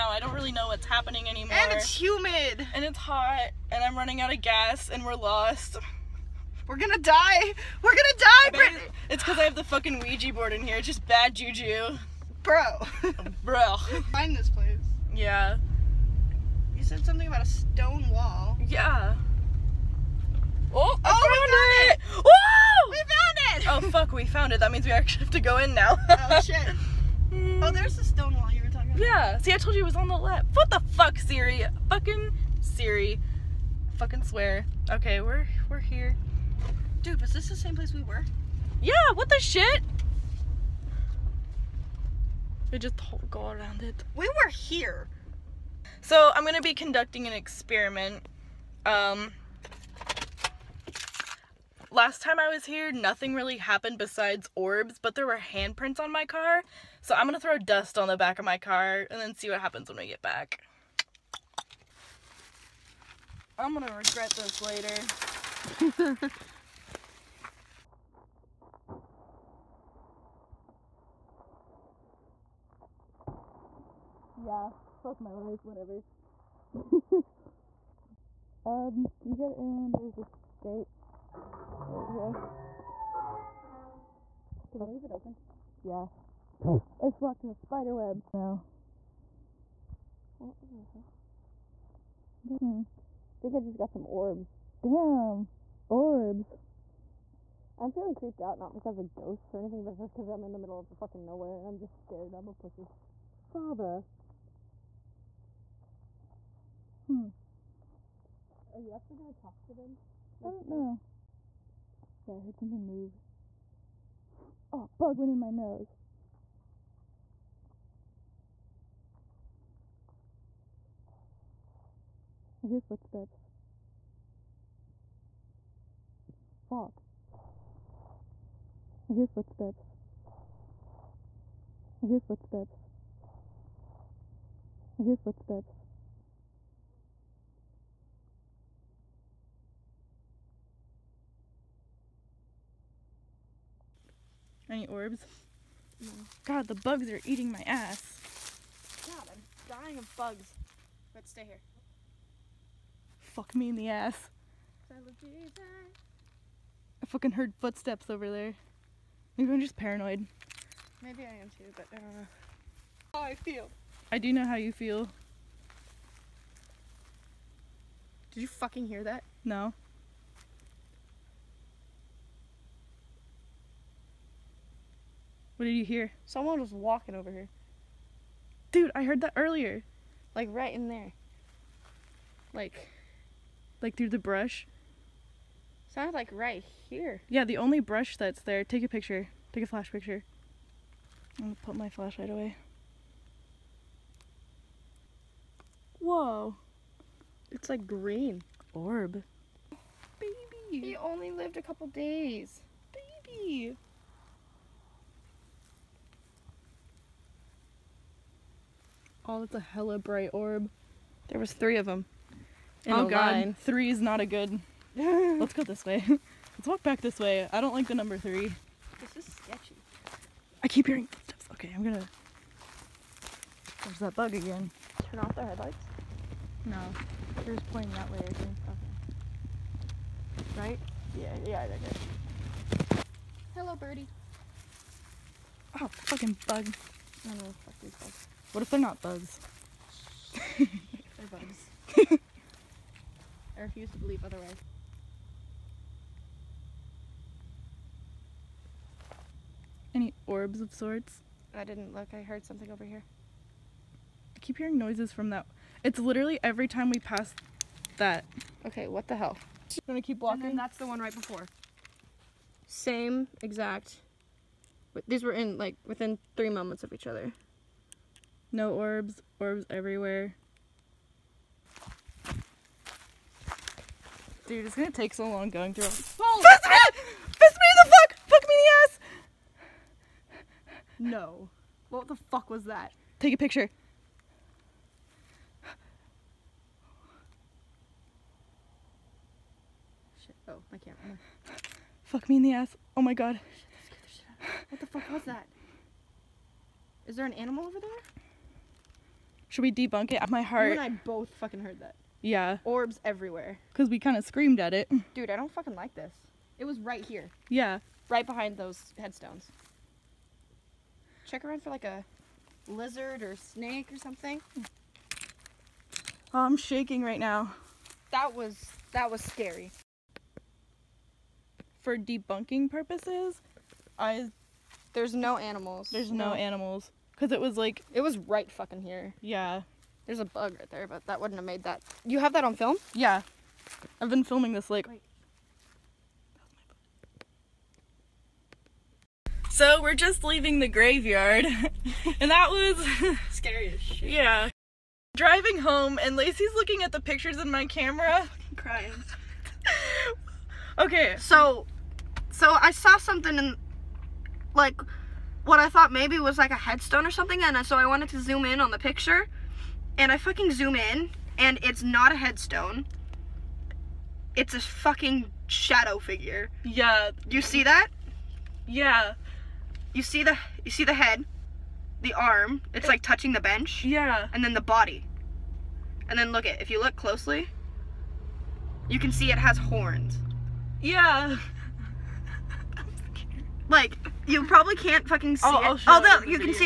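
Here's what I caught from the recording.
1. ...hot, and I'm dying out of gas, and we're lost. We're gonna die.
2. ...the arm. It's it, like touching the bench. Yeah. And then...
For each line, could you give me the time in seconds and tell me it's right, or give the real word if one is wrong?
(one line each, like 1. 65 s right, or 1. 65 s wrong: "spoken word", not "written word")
1. 2 s wrong: "running", not "dying"
2. 372 s right.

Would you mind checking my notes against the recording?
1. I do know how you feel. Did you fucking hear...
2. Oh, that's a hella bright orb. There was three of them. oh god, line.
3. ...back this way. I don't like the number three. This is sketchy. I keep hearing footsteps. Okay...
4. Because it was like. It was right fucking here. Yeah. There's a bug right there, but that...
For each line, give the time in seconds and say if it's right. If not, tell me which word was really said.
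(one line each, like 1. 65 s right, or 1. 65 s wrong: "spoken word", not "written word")
1. 164 s right
2. 209 s right
3. 216 s right
4. 327 s right.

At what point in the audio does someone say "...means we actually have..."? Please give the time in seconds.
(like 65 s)
24 s.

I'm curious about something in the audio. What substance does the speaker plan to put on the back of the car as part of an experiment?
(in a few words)
dust.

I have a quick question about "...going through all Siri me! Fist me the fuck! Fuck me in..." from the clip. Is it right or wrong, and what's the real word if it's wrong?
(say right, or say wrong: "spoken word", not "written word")
wrong: "Fist", not "Siri".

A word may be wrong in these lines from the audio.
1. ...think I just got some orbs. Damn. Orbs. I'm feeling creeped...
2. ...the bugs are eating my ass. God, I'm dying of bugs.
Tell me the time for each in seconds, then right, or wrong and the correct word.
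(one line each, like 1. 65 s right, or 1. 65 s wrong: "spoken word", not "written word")
1. 93 s right
2. 146 s right.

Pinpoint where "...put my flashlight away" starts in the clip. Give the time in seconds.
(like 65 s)
191 s.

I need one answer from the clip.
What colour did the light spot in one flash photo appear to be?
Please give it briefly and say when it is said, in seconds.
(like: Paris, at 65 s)
green, at 197 s.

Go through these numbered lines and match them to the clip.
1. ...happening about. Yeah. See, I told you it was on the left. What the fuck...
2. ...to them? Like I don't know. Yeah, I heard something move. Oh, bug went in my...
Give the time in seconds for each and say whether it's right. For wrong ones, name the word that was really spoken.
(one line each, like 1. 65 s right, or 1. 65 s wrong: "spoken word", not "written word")
1. 28 s wrong: "talking", not "happening"
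2. 109 s right.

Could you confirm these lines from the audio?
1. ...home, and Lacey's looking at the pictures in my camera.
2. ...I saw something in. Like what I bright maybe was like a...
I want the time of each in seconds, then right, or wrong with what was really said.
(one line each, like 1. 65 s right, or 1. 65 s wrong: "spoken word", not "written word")
1. 345 s right
2. 352 s wrong: "thought", not "bright".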